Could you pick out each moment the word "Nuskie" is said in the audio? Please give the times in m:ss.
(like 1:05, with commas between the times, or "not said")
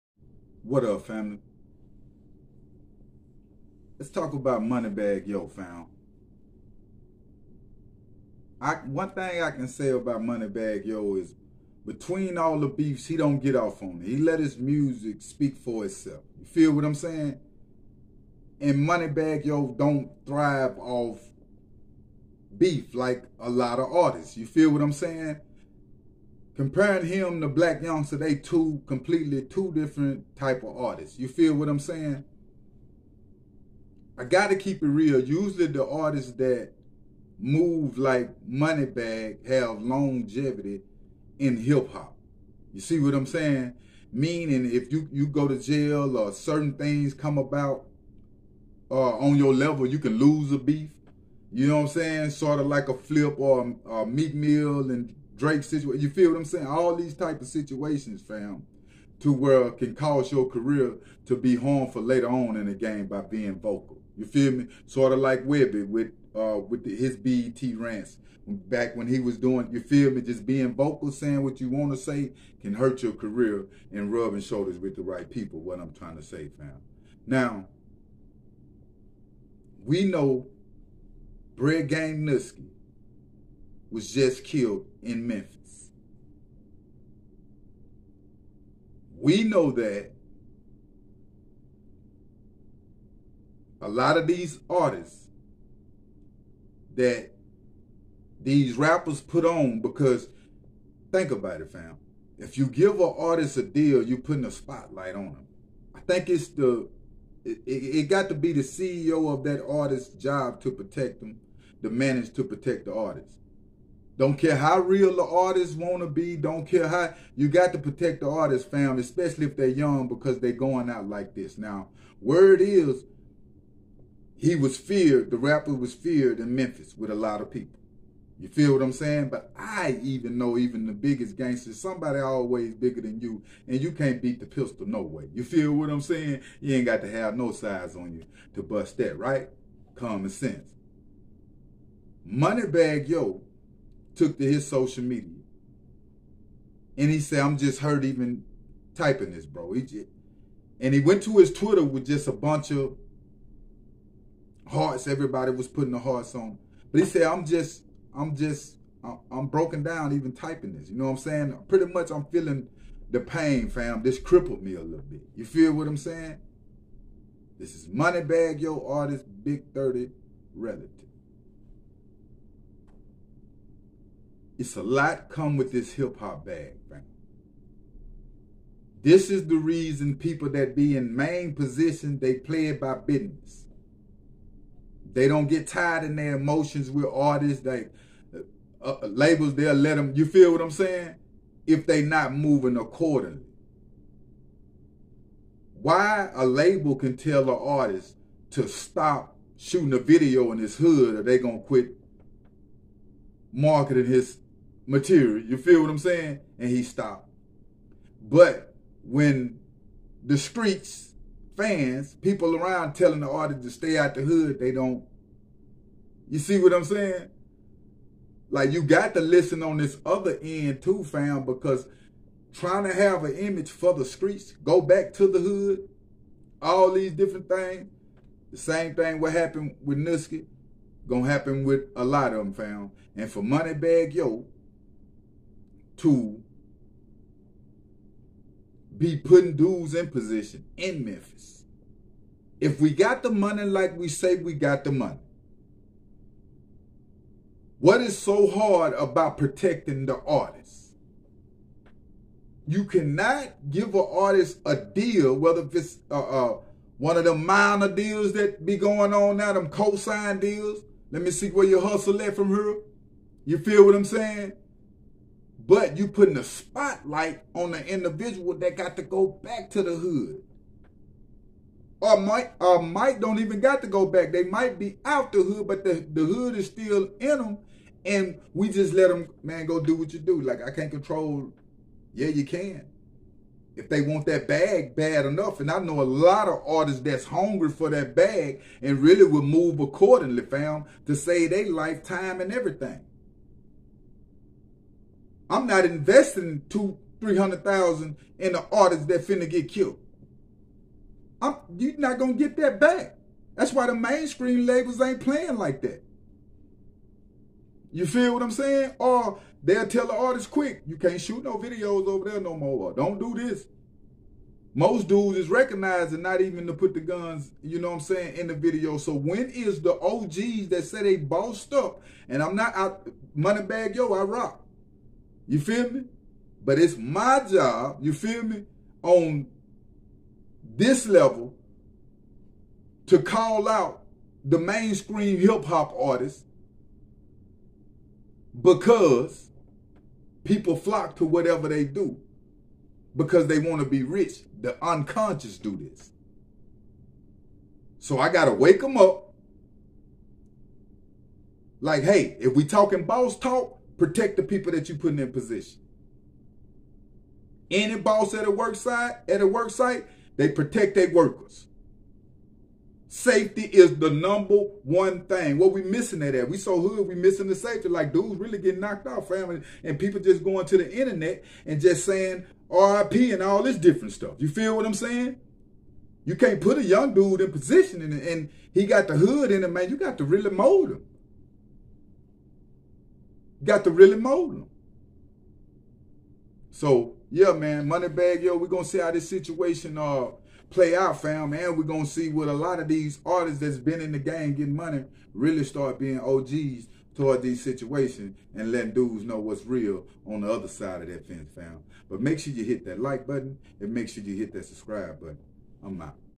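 1:22, 3:49.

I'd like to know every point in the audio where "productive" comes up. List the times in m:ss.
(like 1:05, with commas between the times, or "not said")
not said.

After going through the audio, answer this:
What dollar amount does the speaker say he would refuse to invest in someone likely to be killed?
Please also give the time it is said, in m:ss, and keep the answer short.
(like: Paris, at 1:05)
$200,000-300,000, at 4:56.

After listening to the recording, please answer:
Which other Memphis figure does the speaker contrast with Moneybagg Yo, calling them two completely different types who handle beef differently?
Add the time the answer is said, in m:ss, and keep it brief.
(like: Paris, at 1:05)
Blac Youngsta, at 0:27.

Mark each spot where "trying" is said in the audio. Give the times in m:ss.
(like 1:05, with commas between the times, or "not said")
1:15, 3:42.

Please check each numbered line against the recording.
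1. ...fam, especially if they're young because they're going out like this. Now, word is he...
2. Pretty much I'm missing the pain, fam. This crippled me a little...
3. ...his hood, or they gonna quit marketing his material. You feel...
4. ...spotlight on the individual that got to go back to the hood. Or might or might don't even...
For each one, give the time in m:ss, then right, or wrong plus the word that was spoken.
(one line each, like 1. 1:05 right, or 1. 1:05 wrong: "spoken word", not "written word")
1. 1:58 right
2. 2:41 wrong: "feeling", not "missing"
3. 3:20 right
4. 4:26 right.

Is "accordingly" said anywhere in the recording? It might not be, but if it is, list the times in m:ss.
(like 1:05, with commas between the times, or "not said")
3:12, 4:49.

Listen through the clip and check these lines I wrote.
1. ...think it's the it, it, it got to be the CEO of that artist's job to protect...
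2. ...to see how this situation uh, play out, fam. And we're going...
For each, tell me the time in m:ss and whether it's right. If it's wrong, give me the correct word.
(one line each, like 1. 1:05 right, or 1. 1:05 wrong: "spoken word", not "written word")
1. 1:45 right
2. 6:28 right.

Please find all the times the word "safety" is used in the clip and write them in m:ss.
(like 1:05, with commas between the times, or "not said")
6:03, 6:07.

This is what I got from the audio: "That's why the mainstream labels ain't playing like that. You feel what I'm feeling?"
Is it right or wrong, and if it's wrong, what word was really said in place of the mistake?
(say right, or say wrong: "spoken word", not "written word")
wrong: "saying", not "feeling".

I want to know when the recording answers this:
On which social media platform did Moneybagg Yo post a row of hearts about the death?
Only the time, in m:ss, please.
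2:31.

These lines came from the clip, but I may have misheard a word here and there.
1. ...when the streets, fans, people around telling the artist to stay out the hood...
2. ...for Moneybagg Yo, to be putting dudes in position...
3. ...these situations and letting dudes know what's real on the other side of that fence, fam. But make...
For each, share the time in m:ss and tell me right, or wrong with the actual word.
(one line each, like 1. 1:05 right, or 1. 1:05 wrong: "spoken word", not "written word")
1. 3:29 right
2. 3:53 right
3. 6:37 right.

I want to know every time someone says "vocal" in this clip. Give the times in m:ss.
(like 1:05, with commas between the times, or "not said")
1:03, 1:10.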